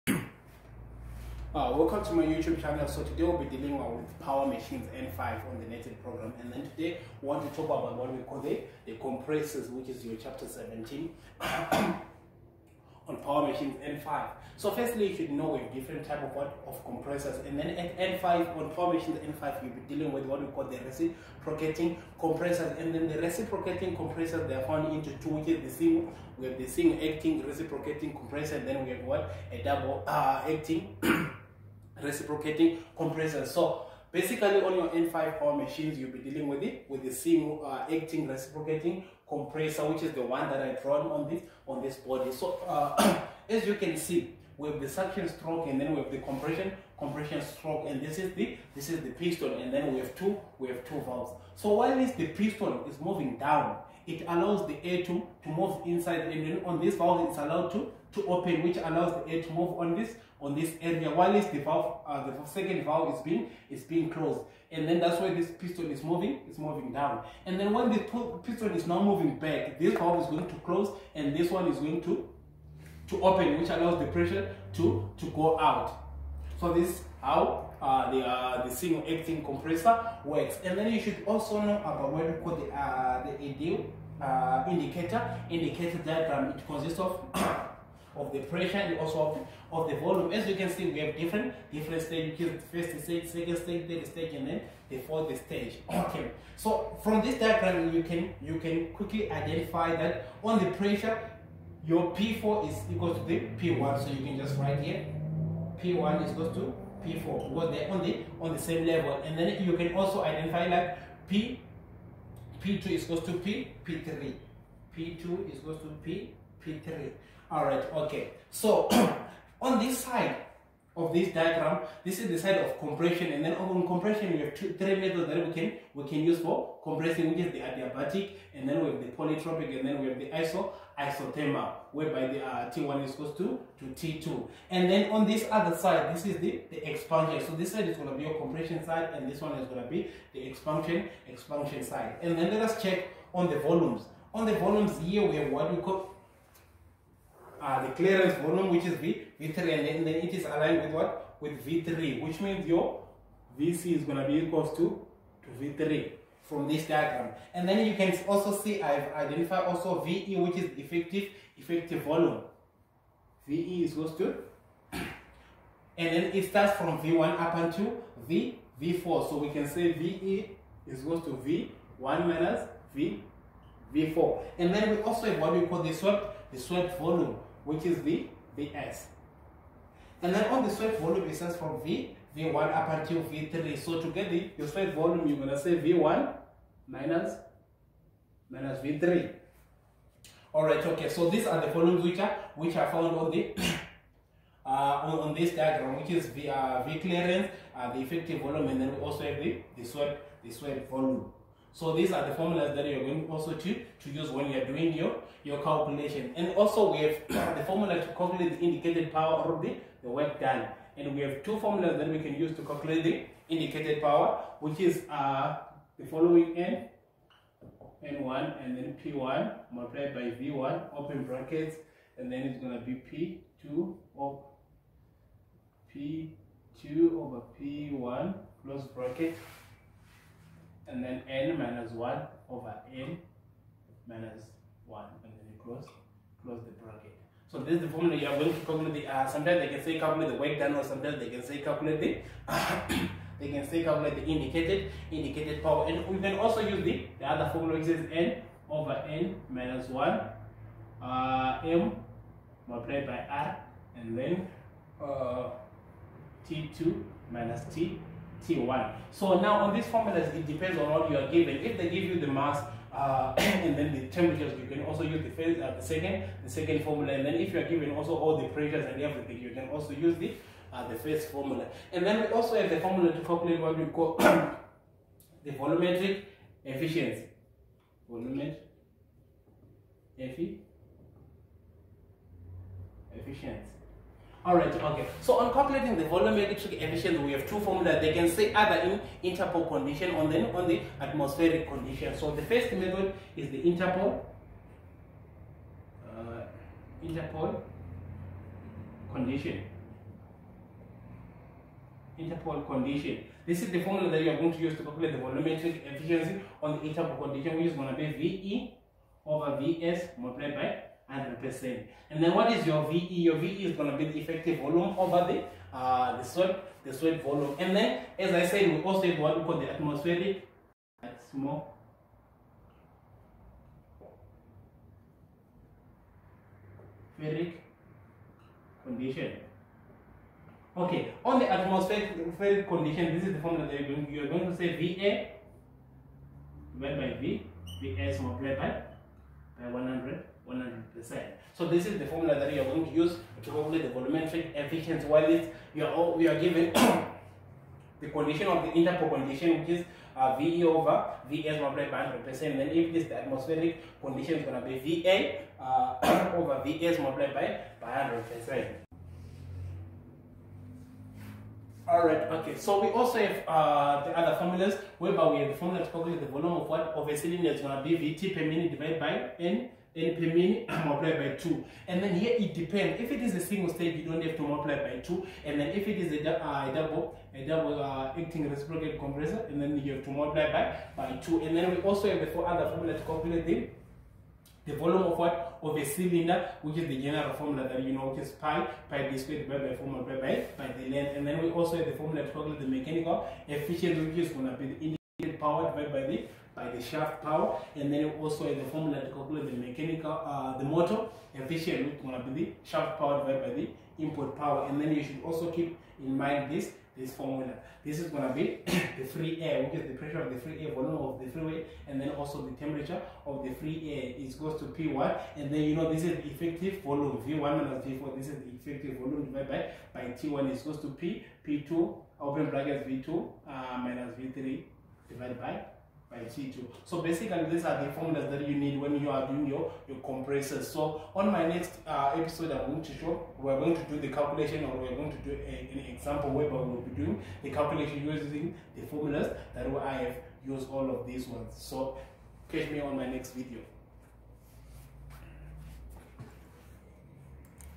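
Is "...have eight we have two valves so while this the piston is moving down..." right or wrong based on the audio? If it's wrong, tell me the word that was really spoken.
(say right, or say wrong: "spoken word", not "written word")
wrong: "two", not "eight".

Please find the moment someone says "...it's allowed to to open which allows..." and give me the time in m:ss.
0:57.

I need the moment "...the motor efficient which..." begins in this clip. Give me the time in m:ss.
6:40.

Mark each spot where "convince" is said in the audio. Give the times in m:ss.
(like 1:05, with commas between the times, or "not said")
not said.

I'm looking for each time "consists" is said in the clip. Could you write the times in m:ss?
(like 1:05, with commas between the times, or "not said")
1:26.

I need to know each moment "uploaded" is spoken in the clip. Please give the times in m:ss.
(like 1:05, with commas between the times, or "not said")
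not said.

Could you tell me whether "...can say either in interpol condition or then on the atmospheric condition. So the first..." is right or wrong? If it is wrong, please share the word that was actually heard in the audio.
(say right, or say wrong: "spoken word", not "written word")
right.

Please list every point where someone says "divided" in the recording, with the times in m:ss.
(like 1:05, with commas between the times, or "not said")
5:36, 6:08, 6:29, 6:35, 6:43, 6:59, 7:05.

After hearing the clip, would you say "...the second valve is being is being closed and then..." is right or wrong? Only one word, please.
right.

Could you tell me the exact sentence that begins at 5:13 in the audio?
Your VE is going to be the effective volume over the, uh, the swept the swept volume.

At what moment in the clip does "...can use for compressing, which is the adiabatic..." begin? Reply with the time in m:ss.
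2:06.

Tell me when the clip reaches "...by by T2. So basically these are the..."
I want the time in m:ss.
7:05.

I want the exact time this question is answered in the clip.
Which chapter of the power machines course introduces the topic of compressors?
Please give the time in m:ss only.
0:10.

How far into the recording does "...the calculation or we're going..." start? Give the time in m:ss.
7:13.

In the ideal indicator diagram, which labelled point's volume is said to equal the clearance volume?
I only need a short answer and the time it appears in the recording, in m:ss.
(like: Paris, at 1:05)
V3, at 2:33.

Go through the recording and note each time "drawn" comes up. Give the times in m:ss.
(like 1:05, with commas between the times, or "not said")
0:40.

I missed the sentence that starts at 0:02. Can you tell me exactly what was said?
So today we'll be dealing with power machines N5 on the Nated program.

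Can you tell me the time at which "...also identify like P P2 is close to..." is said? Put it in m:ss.
1:49.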